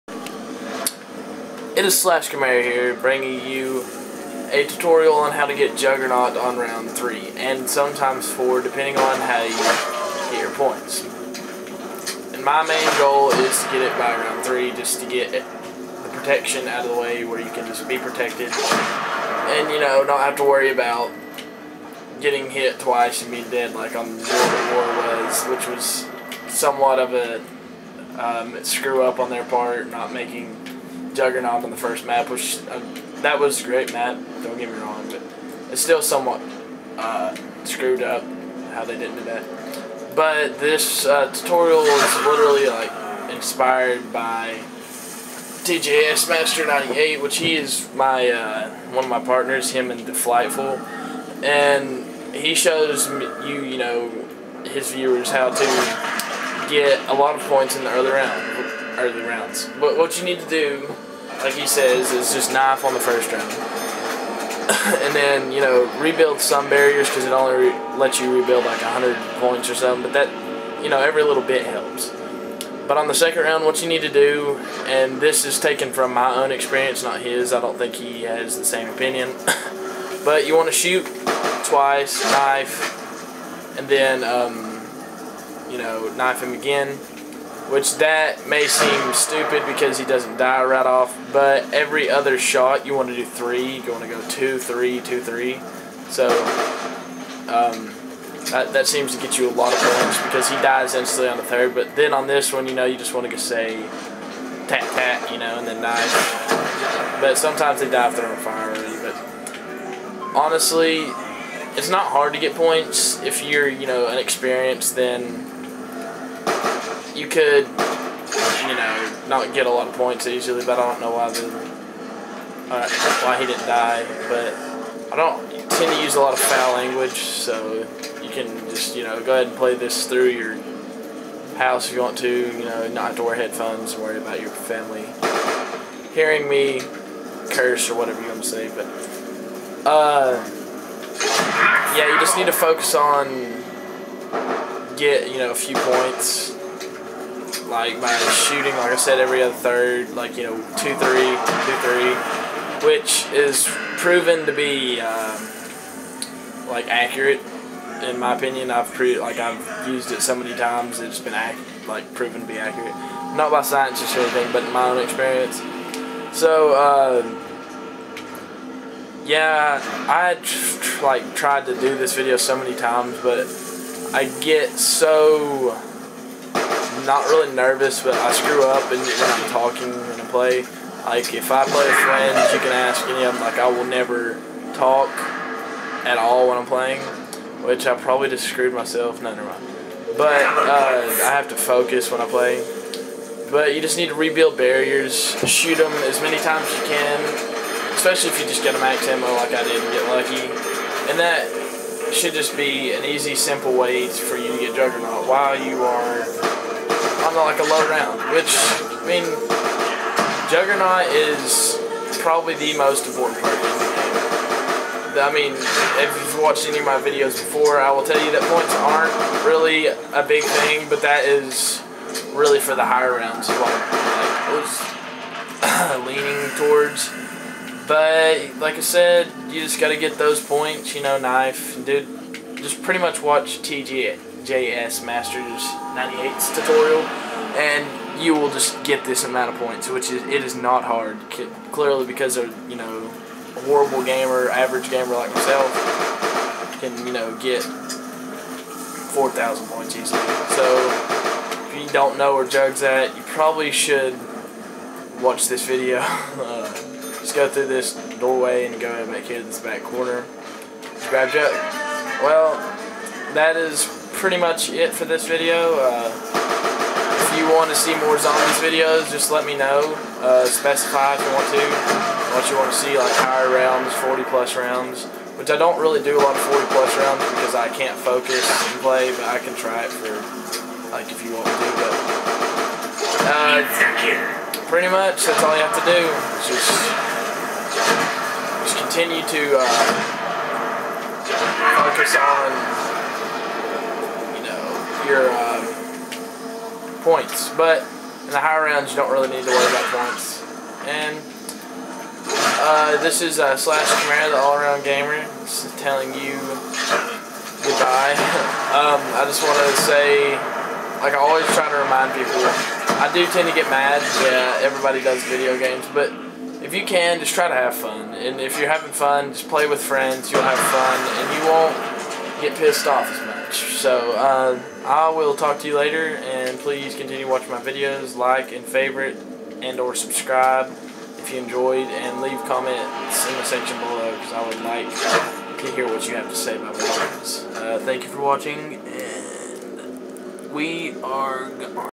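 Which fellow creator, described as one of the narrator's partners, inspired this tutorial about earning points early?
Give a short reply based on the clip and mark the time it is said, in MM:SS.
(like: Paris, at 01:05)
TJS Master 98, at 00:45.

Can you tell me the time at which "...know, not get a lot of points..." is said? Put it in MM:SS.
01:58.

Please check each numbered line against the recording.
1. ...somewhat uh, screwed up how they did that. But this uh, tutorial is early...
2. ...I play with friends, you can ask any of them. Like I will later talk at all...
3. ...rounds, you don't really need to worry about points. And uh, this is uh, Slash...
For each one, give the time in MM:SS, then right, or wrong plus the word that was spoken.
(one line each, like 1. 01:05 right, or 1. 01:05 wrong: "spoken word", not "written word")
1. 00:36 wrong: "literally", not "early"
2. 03:01 wrong: "never", not "later"
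3. 04:58 right.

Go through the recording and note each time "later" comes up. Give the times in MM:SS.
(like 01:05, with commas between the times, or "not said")
05:25.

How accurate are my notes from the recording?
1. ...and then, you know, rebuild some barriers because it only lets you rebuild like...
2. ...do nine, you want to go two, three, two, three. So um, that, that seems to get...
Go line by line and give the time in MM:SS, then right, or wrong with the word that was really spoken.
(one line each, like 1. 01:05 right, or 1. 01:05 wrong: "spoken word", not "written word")
1. 01:05 right
2. 01:33 wrong: "three", not "nine".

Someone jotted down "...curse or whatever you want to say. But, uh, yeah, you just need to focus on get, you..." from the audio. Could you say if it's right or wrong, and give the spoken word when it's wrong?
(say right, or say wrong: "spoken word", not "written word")
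right.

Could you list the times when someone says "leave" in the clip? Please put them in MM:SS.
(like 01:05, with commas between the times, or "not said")
05:32.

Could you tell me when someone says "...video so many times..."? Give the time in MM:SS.
02:52.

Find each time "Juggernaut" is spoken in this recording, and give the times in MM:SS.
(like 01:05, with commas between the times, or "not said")
00:05, 00:31, 03:24, 03:30.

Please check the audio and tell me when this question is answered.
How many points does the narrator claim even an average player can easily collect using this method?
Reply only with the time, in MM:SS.
04:07.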